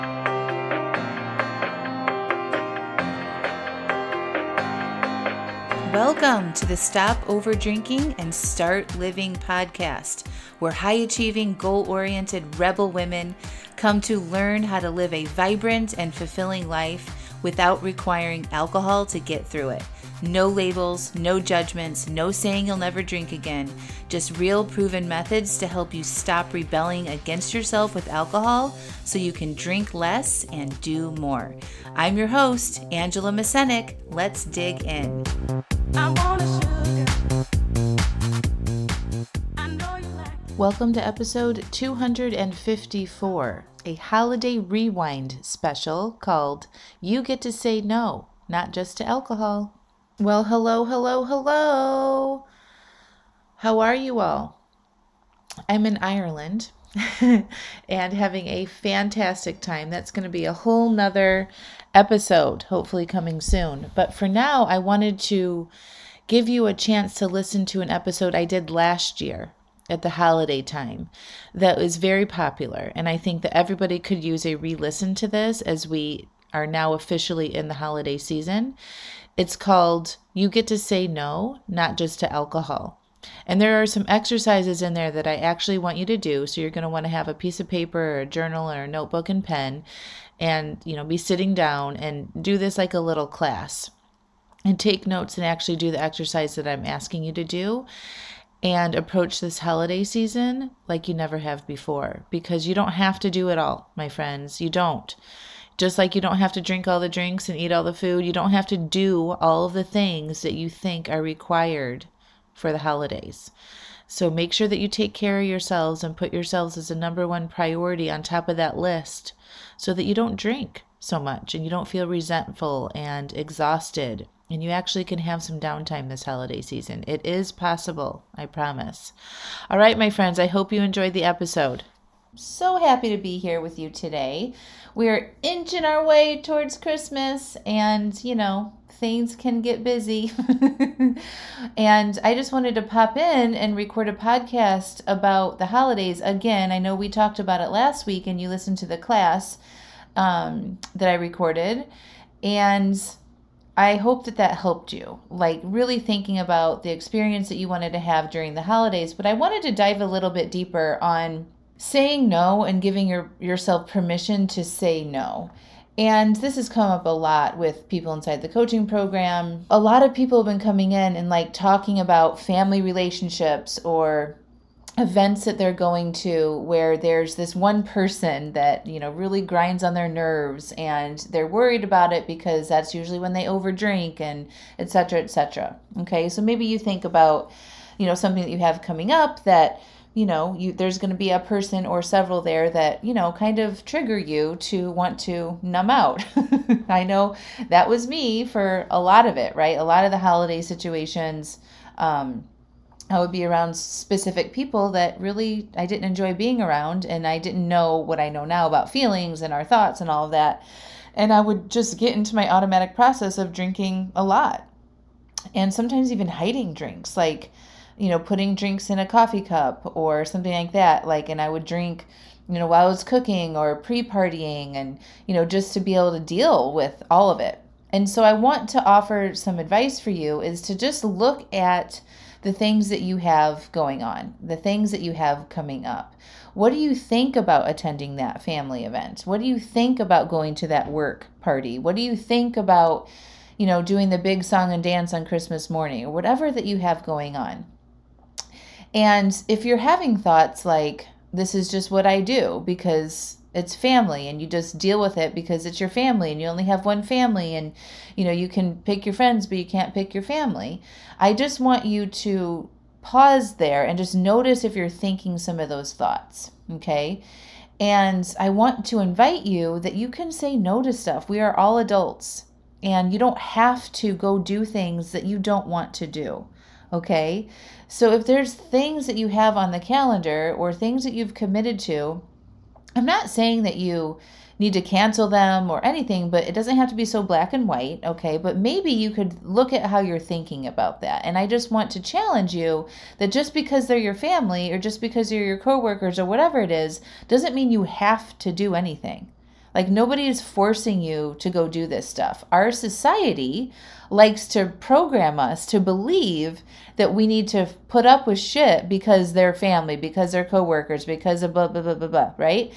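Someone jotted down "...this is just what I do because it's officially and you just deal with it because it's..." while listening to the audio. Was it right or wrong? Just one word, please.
wrong.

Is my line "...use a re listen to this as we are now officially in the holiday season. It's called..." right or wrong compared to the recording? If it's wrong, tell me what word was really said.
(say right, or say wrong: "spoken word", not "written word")
right.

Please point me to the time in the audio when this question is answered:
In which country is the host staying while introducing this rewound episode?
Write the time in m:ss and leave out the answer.
0:56.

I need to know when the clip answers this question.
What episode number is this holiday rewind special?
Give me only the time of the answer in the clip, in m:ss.
0:41.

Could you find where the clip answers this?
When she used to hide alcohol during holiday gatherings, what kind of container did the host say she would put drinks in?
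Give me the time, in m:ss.
3:39.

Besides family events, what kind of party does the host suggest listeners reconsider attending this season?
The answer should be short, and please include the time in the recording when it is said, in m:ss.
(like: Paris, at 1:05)
work party, at 4:00.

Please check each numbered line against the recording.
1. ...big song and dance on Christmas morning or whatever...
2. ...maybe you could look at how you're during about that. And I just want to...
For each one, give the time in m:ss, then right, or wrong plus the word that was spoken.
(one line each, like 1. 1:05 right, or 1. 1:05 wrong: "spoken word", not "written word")
1. 4:04 right
2. 4:48 wrong: "thinking", not "during".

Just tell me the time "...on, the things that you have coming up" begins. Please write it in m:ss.
3:54.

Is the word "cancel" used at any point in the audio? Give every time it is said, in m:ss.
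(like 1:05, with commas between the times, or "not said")
4:44.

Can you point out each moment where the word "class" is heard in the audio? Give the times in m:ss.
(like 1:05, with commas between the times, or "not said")
1:33, 2:28.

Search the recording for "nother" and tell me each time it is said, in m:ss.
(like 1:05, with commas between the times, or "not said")
1:00.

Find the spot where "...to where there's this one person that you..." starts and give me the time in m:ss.
2:56.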